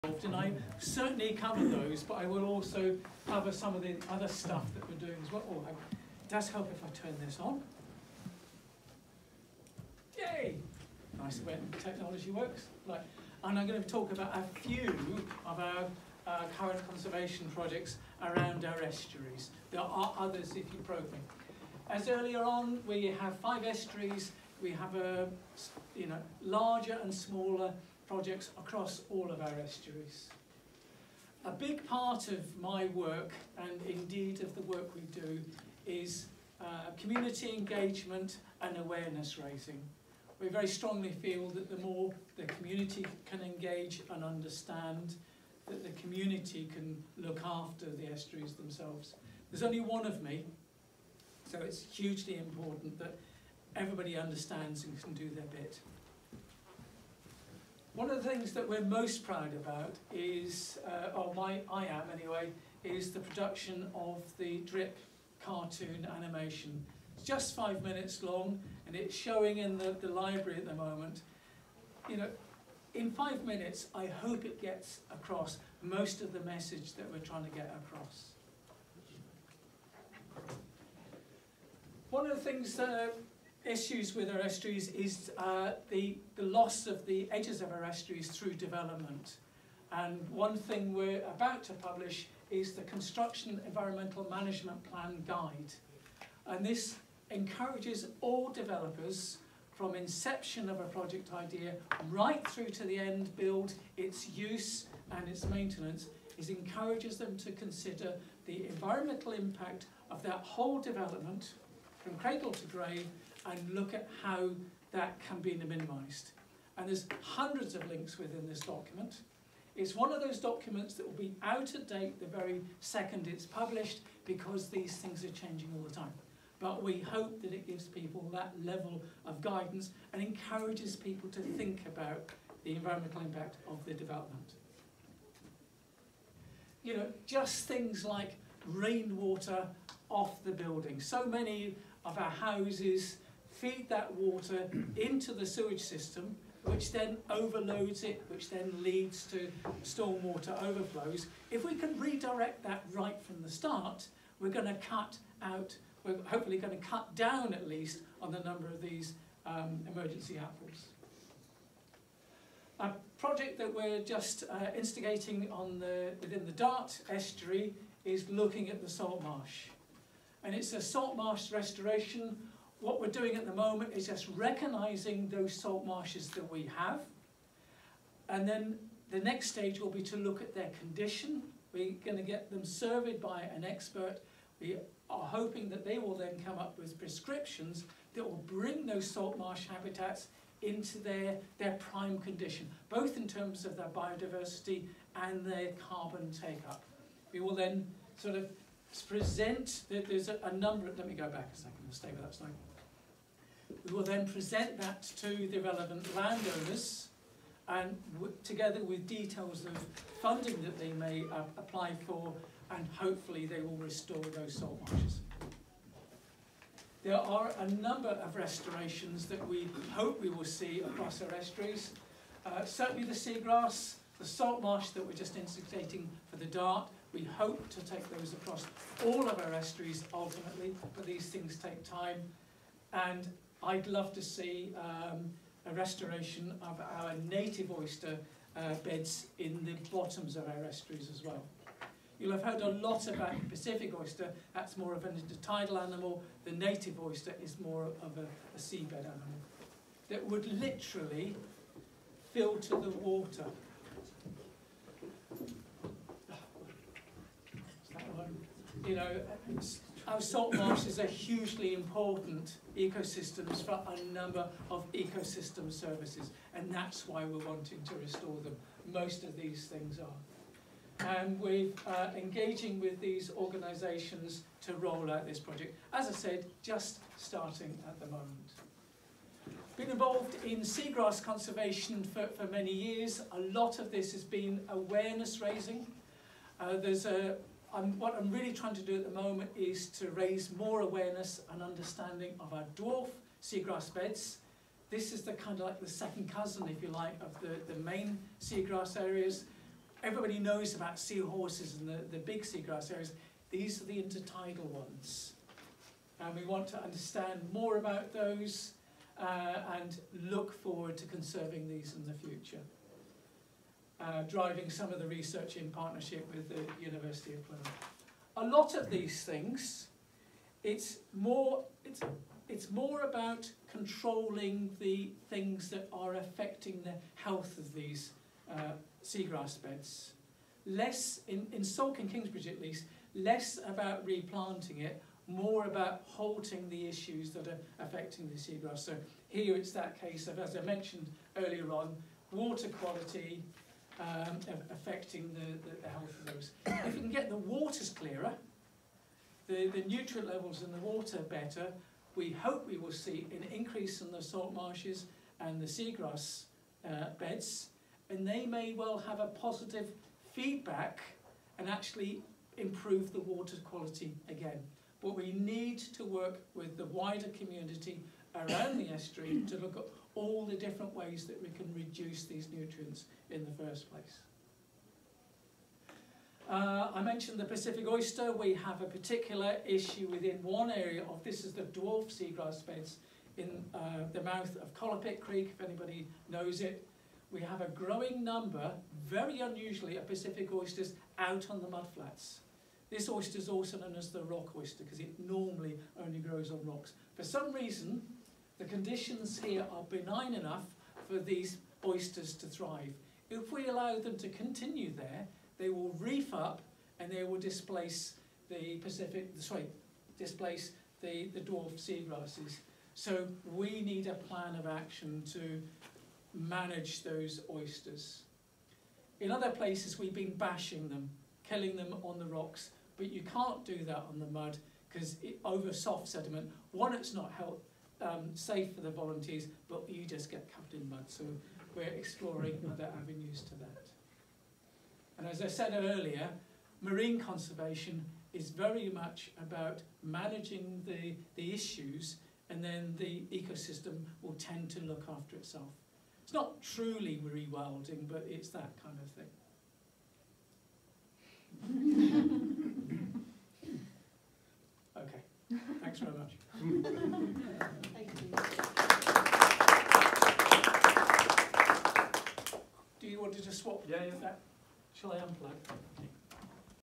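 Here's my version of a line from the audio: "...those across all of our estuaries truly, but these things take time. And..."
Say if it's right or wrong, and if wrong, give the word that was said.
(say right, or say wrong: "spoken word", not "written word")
wrong: "ultimately", not "truly".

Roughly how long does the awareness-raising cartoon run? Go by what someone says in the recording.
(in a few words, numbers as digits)
5 minutes.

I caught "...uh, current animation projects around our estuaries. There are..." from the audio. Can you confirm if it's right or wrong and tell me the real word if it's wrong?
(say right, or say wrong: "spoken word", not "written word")
wrong: "conservation", not "animation".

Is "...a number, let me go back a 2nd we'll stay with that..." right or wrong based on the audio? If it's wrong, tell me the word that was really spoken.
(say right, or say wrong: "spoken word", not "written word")
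right.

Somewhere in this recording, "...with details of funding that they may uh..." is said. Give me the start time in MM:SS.
03:28.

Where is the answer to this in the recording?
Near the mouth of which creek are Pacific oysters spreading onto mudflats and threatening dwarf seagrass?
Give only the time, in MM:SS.
06:24.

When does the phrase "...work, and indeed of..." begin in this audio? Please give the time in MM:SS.
00:32.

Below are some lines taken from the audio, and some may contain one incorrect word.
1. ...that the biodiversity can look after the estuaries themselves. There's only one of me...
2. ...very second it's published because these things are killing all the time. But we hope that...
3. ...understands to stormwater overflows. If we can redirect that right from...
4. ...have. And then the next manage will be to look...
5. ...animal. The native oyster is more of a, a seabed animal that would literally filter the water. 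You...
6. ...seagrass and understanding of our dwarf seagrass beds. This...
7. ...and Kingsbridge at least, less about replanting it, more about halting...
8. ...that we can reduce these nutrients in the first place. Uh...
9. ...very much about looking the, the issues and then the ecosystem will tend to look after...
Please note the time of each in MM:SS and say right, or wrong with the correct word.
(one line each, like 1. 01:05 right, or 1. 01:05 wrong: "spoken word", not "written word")
1. 00:45 wrong: "community", not "biodiversity"
2. 02:02 wrong: "changing", not "killing"
3. 02:28 wrong: "leads", not "understands"
4. 02:56 wrong: "stage", not "manage"
5. 04:05 right
6. 04:50 wrong: "awareness", not "seagrass"
7. 05:32 right
8. 06:11 right
9. 07:18 wrong: "managing", not "looking".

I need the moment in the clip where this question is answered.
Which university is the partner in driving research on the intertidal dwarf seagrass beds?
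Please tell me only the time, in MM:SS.
05:16.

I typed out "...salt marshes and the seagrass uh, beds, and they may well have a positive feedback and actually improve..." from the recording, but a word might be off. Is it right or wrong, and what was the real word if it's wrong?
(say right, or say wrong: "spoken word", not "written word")
right.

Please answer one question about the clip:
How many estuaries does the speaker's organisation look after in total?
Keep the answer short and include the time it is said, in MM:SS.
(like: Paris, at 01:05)
5, at 00:23.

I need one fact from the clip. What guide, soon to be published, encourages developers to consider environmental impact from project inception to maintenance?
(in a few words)
Construction Environmental Management Plan Guide.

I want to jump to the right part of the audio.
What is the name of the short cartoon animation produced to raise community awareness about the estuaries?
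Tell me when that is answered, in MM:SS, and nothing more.
01:04.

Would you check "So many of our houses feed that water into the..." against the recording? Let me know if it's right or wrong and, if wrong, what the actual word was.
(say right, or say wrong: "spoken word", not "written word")
right.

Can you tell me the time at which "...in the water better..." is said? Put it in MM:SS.
05:50.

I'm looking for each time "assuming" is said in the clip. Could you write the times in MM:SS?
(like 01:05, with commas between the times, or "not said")
not said.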